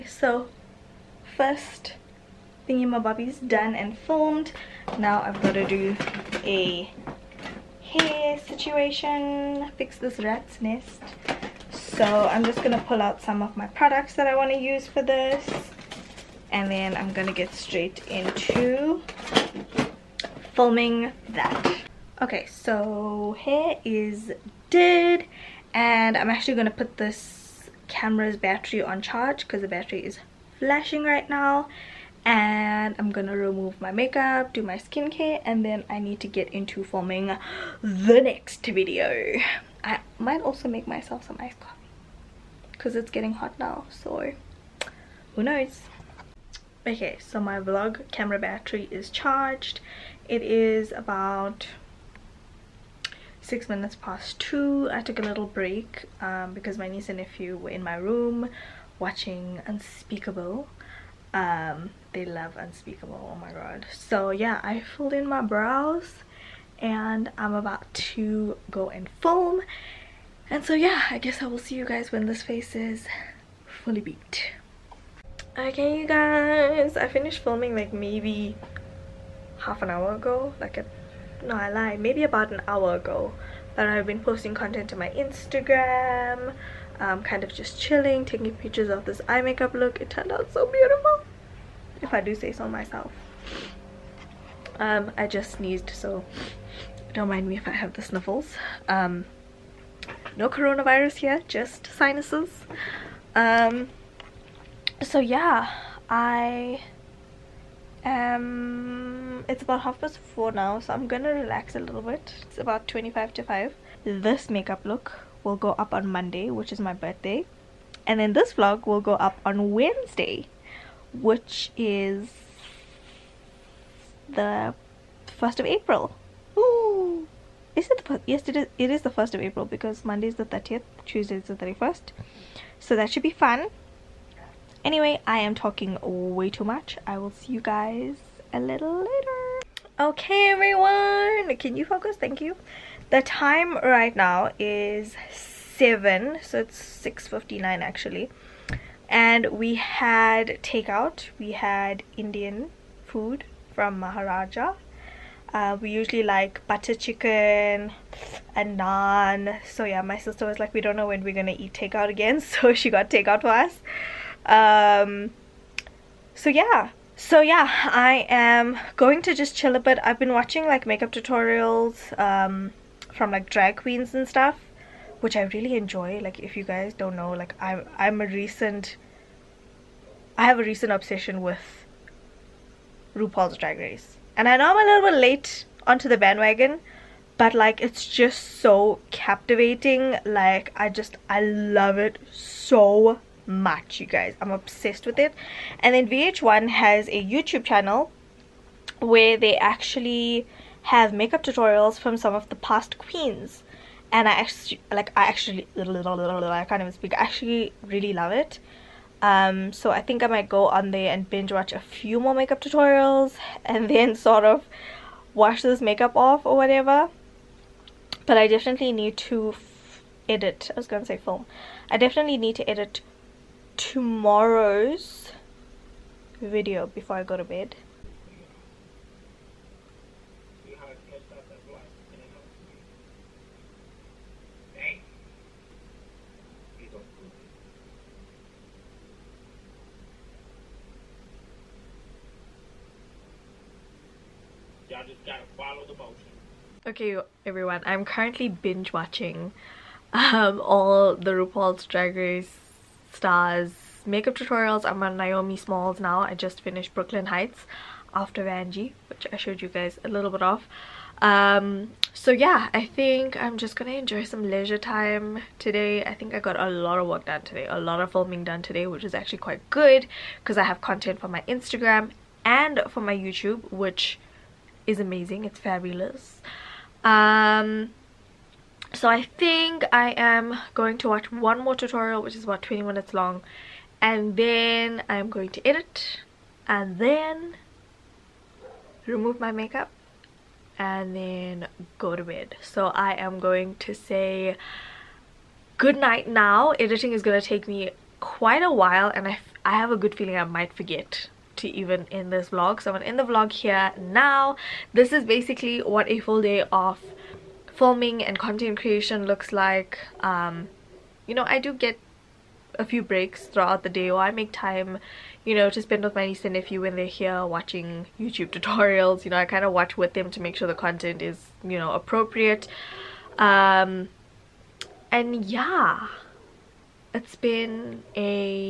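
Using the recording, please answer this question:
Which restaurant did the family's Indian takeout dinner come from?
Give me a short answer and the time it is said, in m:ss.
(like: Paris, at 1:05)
Maharaja, at 2:33.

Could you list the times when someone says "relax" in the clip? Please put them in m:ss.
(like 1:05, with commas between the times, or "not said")
1:51.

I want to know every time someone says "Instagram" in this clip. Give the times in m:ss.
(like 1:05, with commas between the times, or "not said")
1:25, 4:31.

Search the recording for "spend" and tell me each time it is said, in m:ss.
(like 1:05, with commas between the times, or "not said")
5:15.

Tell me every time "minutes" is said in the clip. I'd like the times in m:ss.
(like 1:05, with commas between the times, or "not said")
0:53, 4:42.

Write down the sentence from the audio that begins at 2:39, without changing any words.
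So yeah, my sister was like, we don't know when we're going to eat takeout again.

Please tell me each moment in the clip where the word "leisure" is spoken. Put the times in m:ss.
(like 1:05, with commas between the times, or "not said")
4:24.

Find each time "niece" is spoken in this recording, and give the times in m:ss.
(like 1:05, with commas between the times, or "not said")
0:56, 5:16.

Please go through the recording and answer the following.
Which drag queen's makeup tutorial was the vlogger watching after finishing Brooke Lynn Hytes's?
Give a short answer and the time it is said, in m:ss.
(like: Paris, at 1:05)
Naomi Smalls, at 4:15.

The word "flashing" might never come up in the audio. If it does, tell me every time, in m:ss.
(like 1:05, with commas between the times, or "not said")
0:30.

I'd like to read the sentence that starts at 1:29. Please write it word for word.
It turned out so beautiful, if I do say so myself.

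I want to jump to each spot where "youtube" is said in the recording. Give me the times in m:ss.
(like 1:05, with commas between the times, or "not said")
3:17, 4:33, 5:18.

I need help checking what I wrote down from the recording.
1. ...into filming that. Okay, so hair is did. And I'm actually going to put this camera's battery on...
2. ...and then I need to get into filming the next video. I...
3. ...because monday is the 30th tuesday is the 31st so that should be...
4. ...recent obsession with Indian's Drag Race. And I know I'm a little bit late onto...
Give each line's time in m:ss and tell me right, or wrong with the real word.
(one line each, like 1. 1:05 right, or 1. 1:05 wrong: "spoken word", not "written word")
1. 0:18 right
2. 0:35 right
3. 2:09 right
4. 3:00 wrong: "RuPaul", not "Indian".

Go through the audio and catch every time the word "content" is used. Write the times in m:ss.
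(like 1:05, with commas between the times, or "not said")
1:24, 4:30, 5:08, 5:20.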